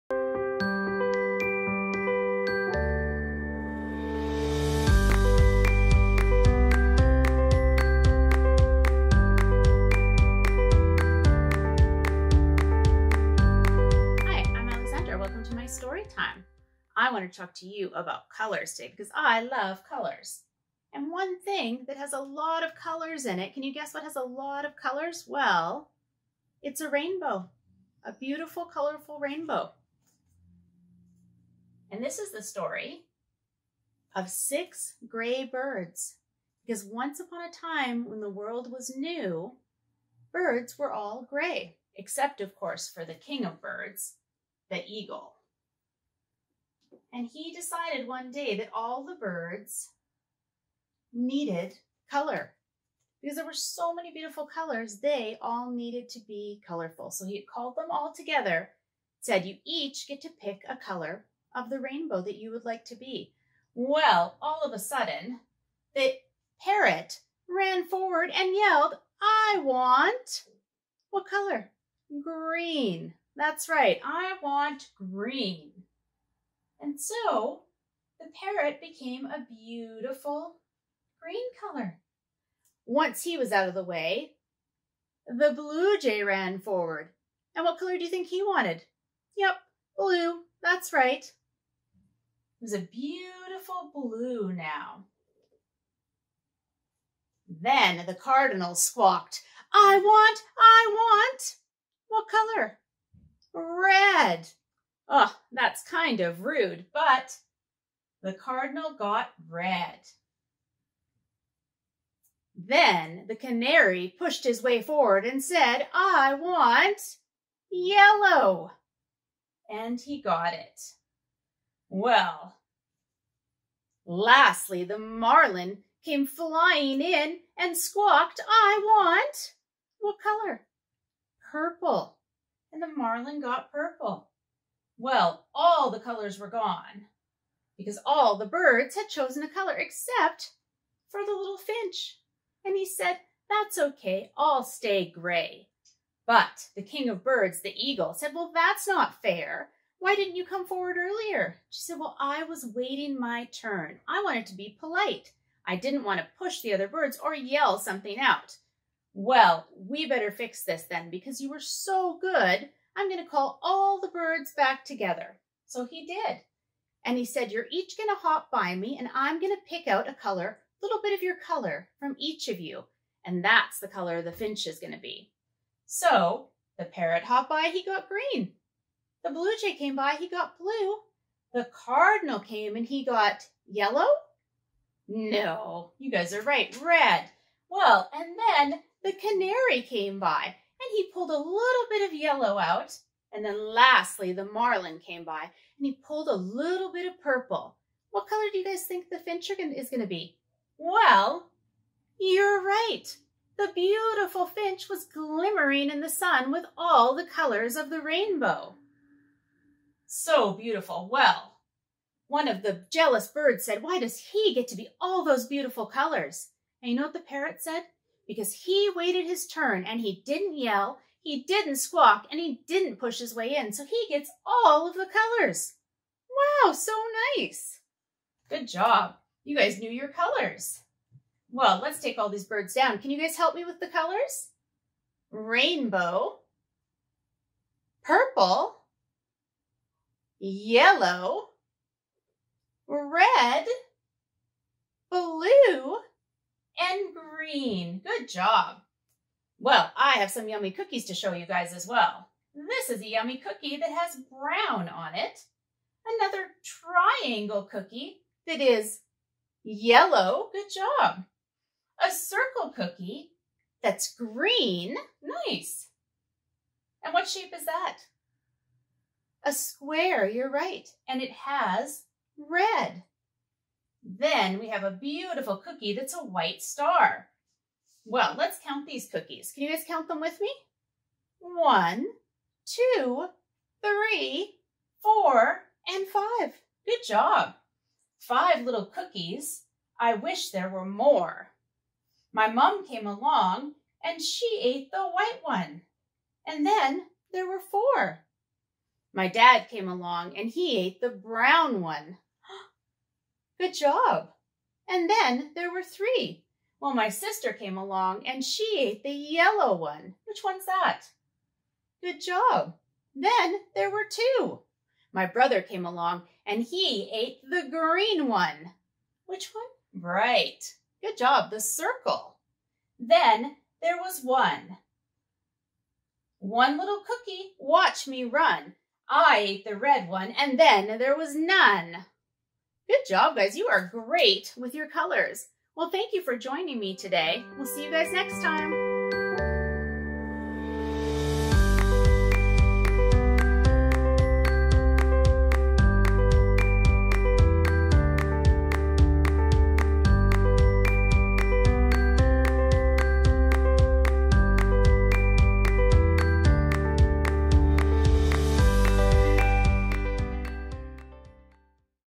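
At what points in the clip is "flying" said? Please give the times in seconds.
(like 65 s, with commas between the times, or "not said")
126 s.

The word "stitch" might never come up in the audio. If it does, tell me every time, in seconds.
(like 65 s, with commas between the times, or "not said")
not said.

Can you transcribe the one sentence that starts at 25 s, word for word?
Well, it's a rainbow, a beautiful, colorful rainbow.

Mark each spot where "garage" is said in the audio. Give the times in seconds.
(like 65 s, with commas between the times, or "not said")
not said.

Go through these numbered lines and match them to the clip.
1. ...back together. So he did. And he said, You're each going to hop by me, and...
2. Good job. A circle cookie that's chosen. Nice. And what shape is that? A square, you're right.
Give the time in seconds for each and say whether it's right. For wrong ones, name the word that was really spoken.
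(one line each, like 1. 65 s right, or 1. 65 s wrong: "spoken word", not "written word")
1. 164 s right
2. 260 s wrong: "green", not "chosen".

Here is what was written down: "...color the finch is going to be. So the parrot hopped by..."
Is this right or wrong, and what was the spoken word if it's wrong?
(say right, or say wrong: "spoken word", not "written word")
right.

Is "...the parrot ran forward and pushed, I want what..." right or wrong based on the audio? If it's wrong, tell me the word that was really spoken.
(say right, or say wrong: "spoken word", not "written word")
wrong: "yelled", not "pushed".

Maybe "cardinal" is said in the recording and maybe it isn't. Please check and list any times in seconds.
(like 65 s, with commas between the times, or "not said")
98 s, 108 s, 181 s.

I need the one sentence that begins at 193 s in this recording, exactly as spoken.
And then lastly, the martin came by and he pulled a little bit of purple.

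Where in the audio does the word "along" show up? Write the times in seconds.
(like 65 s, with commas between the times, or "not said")
293 s, 299 s, 307 s, 315 s.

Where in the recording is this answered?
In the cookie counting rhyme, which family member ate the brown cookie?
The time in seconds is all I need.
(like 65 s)
299 s.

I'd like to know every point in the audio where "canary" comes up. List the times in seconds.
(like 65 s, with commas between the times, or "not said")
113 s, 189 s.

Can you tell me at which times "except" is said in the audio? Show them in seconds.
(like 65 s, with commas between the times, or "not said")
41 s, 139 s.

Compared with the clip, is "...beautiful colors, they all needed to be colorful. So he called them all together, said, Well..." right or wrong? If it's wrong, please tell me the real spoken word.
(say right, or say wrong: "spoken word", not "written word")
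wrong: "You", not "Well".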